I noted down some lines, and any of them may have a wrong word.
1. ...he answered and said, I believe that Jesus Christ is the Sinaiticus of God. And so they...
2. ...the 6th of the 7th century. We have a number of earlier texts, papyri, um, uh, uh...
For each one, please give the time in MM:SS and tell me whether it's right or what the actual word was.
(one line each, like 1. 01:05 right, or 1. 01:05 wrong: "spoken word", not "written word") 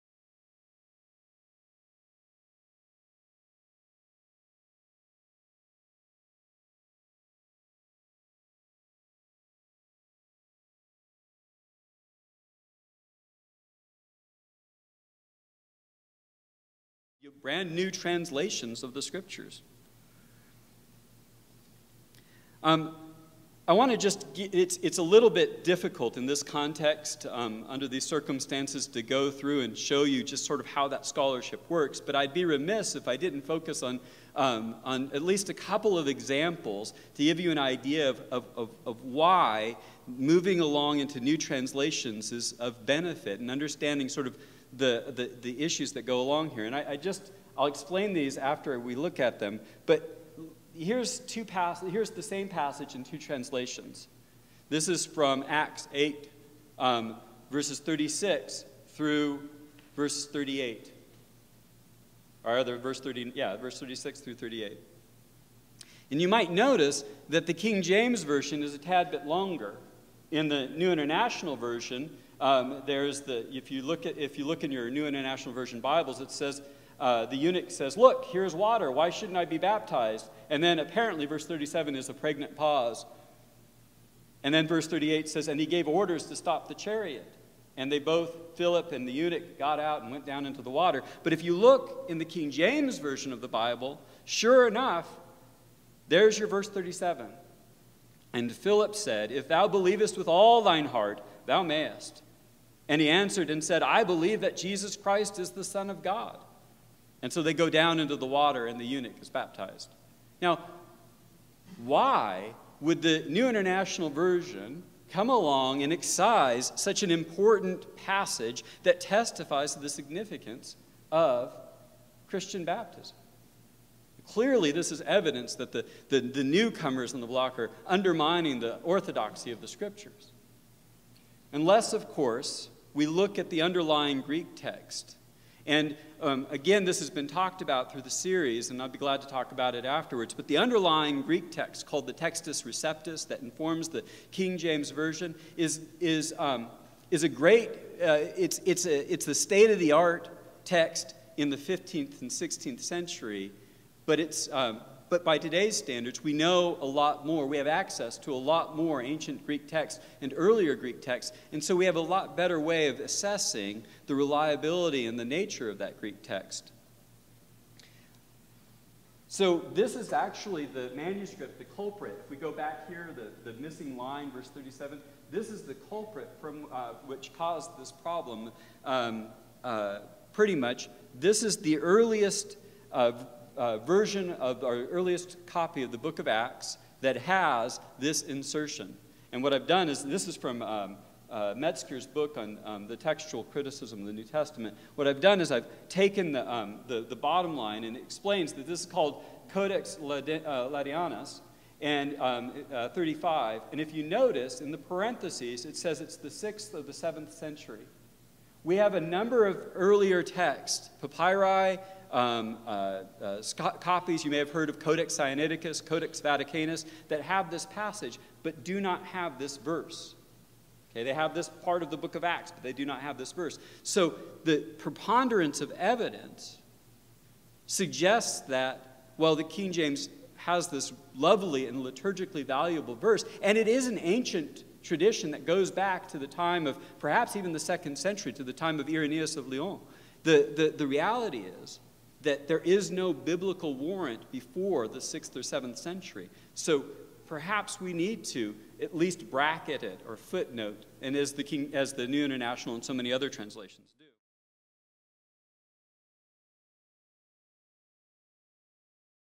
1. 01:43 wrong: "Son", not "Sinaiticus"
2. 03:26 right.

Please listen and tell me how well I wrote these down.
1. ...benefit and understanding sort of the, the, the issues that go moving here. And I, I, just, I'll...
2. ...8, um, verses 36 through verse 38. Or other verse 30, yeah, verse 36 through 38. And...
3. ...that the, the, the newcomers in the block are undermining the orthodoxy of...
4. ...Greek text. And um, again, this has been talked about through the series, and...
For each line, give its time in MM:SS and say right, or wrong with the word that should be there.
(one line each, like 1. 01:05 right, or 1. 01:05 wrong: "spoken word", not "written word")
1. 00:42 wrong: "along", not "moving"
2. 00:55 right
3. 02:05 right
4. 02:14 right.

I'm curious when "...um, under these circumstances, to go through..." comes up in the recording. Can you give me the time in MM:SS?
00:27.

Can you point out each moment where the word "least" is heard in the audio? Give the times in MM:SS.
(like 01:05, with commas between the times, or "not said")
00:35, 04:08.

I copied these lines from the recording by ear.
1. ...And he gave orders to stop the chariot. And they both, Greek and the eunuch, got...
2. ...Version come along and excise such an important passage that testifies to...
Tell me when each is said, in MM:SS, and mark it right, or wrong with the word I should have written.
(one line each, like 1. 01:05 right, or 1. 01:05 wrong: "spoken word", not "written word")
1. 01:25 wrong: "Philip", not "Greek"
2. 01:54 right.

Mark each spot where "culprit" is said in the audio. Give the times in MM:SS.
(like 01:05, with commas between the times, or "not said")
02:51, 02:55.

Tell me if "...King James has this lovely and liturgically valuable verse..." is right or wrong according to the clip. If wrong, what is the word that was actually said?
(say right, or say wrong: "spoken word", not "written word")
right.